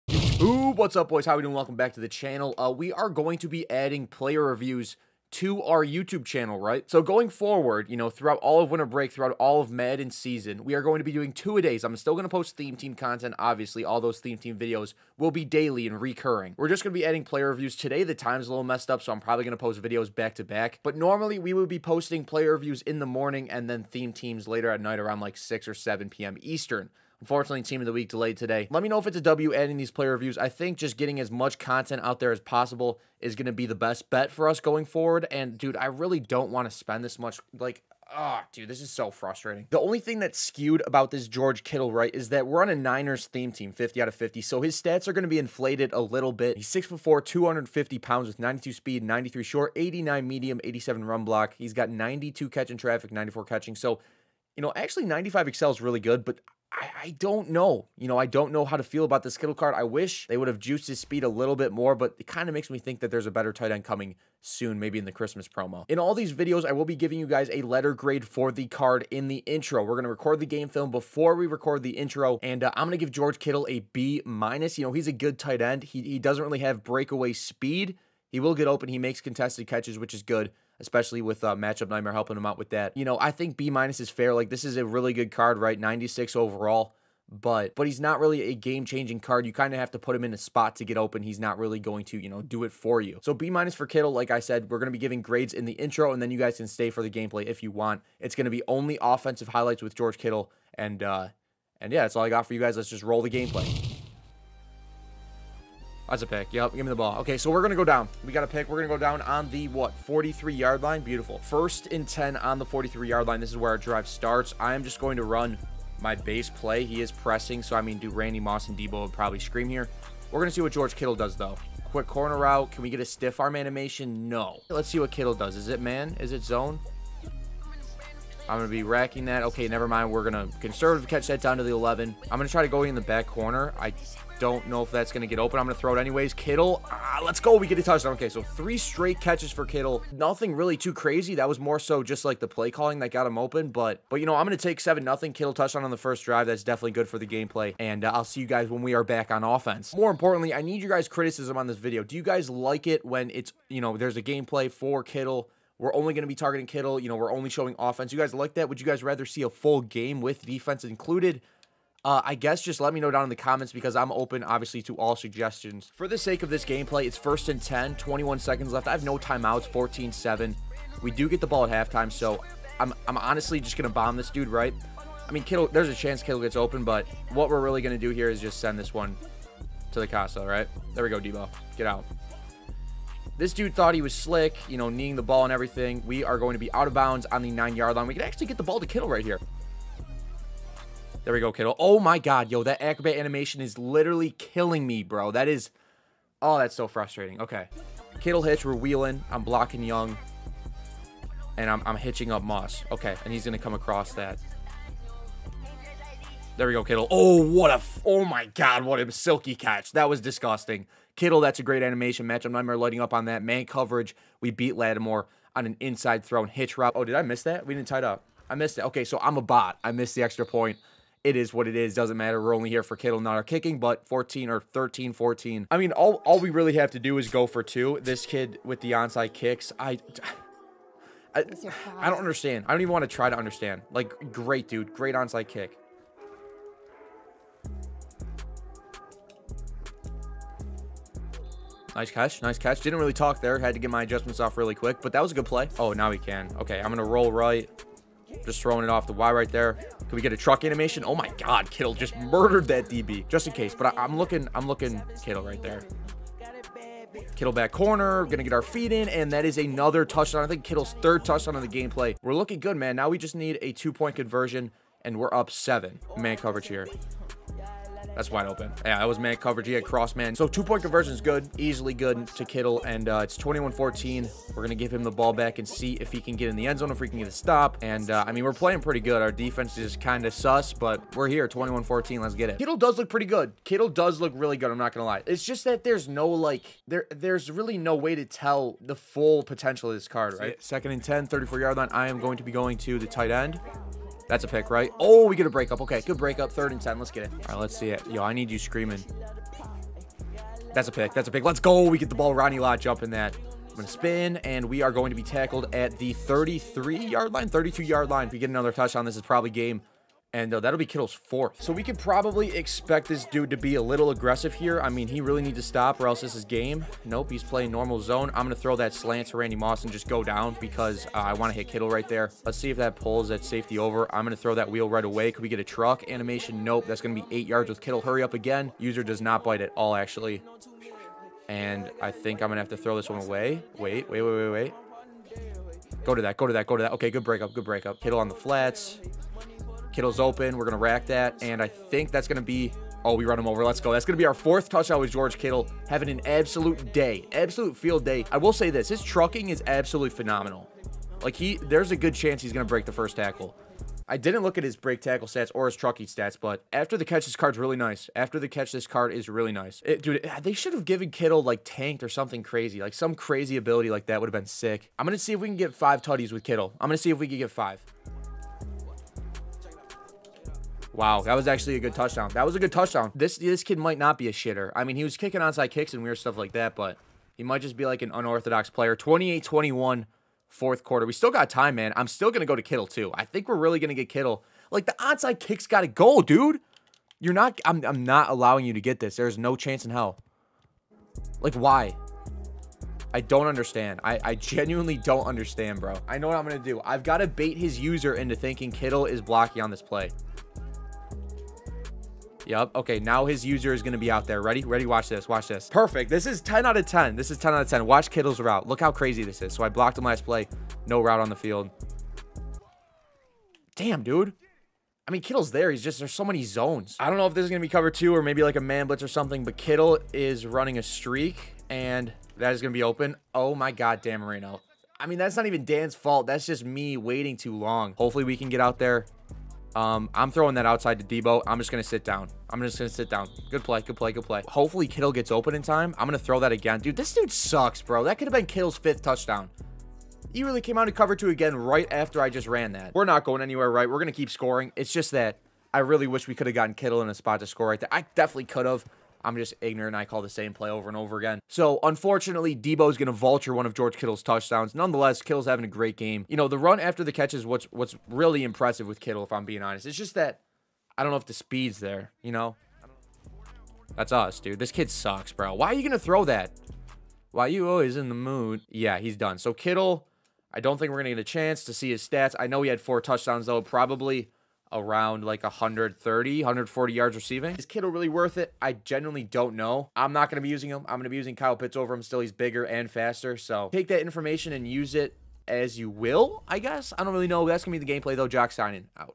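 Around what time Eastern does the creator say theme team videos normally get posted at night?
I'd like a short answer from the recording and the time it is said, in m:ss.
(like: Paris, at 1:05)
6 or 7 p.m., at 0:25.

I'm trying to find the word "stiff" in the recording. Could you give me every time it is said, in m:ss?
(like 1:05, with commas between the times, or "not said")
2:03.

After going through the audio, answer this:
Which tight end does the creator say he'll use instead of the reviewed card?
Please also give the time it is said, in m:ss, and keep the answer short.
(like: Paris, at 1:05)
Kyle Pitts, at 8:01.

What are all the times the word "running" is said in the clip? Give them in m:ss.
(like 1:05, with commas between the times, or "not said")
7:00.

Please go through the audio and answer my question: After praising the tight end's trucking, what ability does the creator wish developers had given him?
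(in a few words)
tanked.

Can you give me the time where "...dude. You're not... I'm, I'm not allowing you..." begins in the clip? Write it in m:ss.
6:26.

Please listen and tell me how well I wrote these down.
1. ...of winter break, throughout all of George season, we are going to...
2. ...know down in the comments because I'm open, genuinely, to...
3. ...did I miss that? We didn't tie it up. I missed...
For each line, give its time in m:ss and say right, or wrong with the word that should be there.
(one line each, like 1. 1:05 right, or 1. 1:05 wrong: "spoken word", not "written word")
1. 0:08 wrong: "Madden", not "George"
2. 2:42 wrong: "obviously", not "genuinely"
3. 3:37 right.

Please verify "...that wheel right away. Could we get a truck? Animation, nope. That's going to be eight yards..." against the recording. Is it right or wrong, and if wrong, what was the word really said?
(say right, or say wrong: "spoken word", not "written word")
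right.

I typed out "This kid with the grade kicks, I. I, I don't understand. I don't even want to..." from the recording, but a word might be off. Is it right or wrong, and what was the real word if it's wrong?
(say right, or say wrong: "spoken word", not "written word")
wrong: "onside", not "grade".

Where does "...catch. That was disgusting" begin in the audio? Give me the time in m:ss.
3:29.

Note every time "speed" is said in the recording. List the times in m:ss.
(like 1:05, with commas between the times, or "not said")
0:48, 1:00, 1:17, 7:41.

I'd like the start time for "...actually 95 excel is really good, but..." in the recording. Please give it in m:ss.
0:54.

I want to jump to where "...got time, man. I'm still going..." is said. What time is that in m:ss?
6:21.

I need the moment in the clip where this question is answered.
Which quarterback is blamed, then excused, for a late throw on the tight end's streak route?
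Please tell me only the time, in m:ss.
7:04.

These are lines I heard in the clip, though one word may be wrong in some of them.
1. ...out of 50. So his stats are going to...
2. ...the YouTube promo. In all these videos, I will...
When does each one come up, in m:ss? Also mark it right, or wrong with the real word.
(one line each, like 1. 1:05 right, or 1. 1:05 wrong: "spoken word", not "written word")
1. 0:44 right
2. 1:05 wrong: "Christmas", not "YouTube".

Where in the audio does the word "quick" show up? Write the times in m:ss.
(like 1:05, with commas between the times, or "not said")
2:01, 4:04.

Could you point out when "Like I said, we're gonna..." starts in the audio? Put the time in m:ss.
1:34.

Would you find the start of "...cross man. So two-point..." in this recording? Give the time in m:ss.
4:29.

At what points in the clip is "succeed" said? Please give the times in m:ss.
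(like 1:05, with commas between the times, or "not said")
not said.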